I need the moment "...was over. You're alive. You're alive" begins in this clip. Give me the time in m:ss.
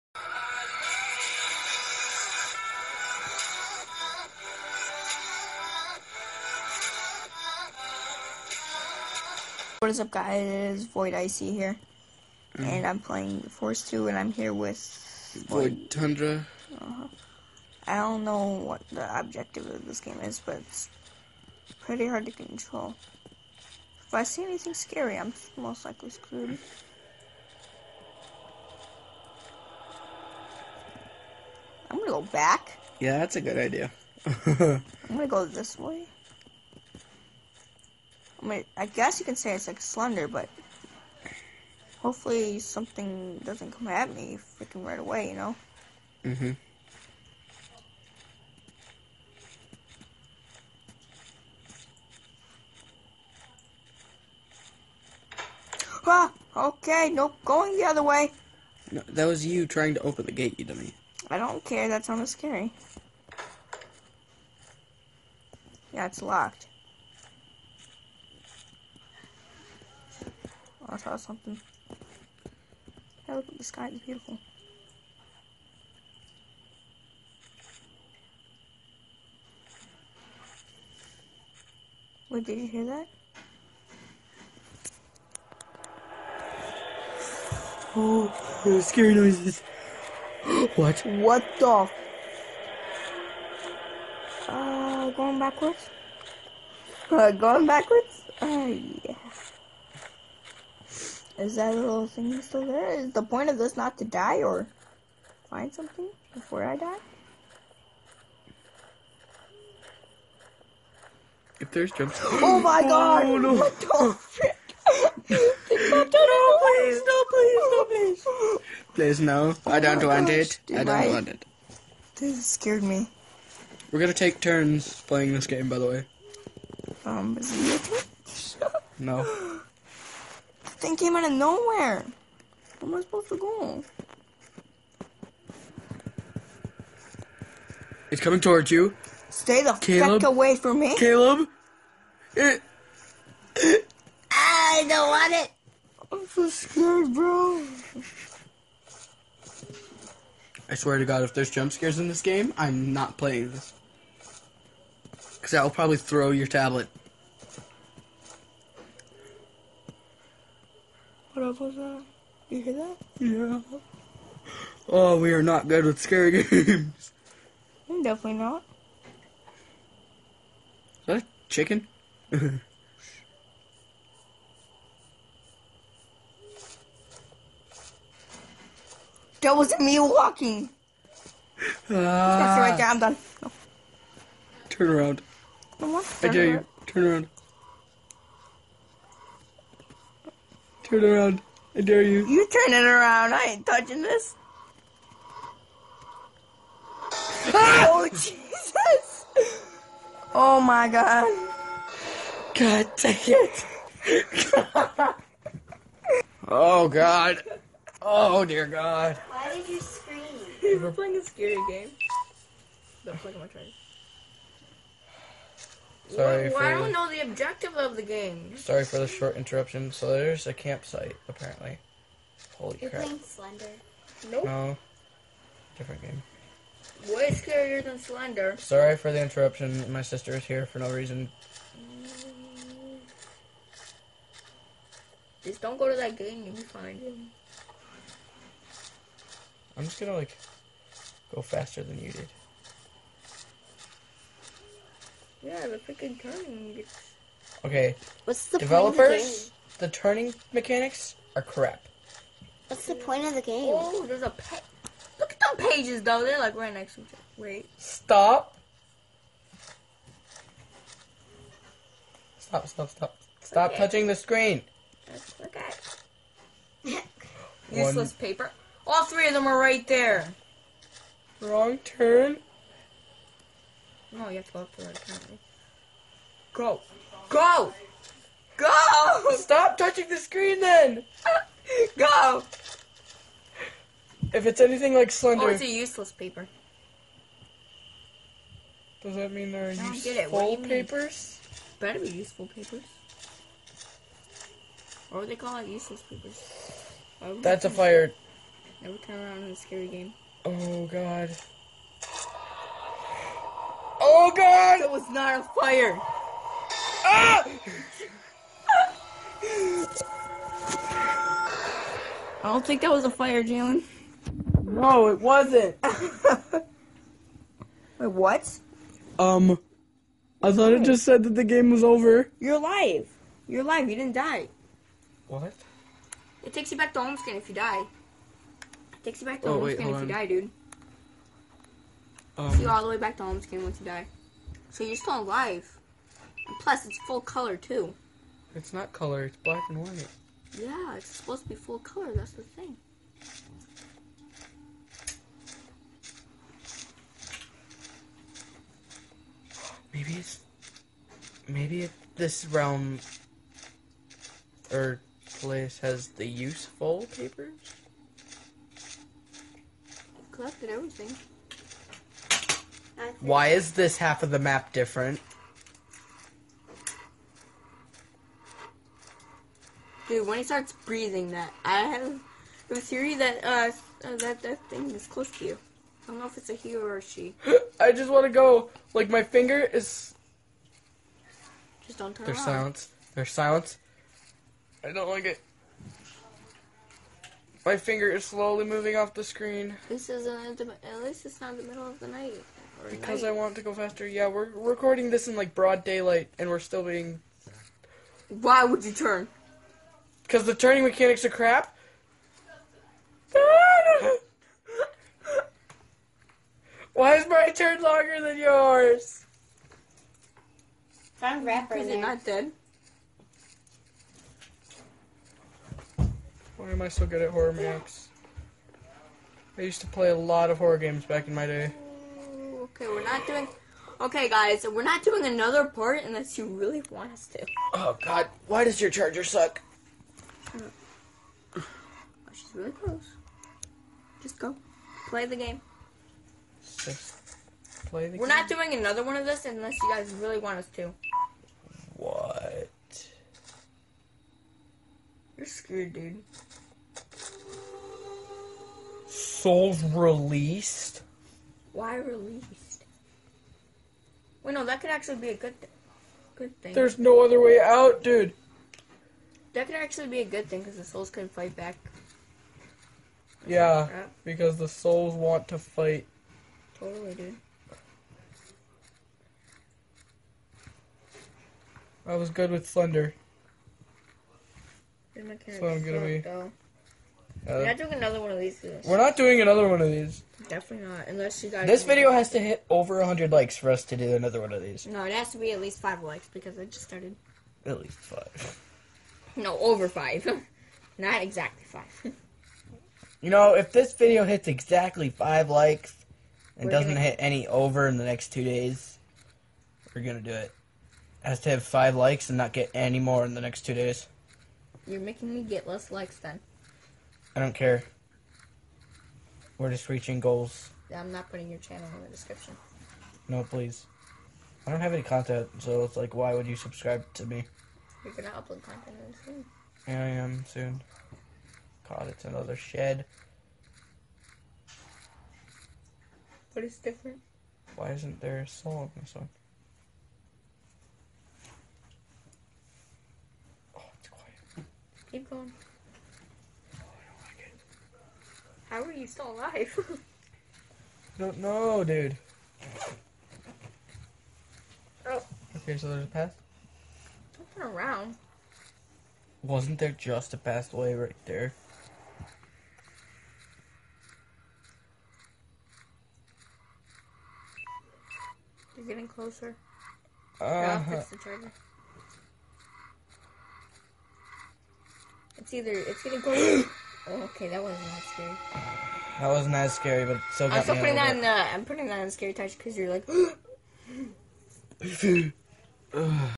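5:21.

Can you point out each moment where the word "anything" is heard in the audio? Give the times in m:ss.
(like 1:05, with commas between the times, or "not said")
0:24, 4:44.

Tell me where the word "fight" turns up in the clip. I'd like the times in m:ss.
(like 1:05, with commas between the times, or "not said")
7:41, 7:45.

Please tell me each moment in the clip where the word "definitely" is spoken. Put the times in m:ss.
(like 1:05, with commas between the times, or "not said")
2:48, 8:00.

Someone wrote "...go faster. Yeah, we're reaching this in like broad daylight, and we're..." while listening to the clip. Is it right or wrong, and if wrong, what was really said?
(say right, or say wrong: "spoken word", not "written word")
wrong: "recording", not "reaching".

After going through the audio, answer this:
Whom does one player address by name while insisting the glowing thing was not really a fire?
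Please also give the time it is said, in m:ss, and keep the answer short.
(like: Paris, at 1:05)
Jalen, at 5:13.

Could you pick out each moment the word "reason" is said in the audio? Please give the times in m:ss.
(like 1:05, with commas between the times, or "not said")
3:50.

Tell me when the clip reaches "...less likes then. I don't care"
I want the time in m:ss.
8:25.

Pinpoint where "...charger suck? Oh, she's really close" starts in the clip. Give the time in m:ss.
7:08.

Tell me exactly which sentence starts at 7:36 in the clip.
There's no other way out, dude.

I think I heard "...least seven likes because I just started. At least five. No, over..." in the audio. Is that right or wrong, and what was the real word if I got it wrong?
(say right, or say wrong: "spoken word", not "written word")
wrong: "five", not "seven".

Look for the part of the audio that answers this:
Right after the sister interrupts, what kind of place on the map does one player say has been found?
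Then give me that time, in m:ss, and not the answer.
3:40.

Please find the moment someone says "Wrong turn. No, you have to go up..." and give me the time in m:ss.
4:31.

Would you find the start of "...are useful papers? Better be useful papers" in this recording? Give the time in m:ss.
4:49.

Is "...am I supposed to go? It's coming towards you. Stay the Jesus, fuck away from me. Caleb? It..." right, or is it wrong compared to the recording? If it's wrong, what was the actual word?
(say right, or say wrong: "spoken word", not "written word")
wrong: "Caleb", not "Jesus".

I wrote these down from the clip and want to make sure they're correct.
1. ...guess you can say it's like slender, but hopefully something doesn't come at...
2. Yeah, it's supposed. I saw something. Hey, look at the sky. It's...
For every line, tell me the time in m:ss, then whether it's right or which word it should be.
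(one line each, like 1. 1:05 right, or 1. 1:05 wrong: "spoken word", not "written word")
1. 0:38 right
2. 1:05 wrong: "locked", not "supposed".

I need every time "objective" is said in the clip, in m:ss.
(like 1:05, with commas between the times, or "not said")
0:19, 3:37.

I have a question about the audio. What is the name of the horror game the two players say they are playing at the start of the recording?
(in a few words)
Forest 2.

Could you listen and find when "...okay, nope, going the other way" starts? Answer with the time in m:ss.
0:56.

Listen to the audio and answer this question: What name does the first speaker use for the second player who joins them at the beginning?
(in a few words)
Void Tundra.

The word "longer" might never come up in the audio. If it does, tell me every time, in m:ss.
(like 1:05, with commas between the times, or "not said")
6:47.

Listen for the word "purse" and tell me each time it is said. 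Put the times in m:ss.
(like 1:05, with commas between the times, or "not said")
not said.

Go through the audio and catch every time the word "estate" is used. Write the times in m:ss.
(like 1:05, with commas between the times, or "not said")
not said.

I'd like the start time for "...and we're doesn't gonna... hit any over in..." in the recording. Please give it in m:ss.
8:16.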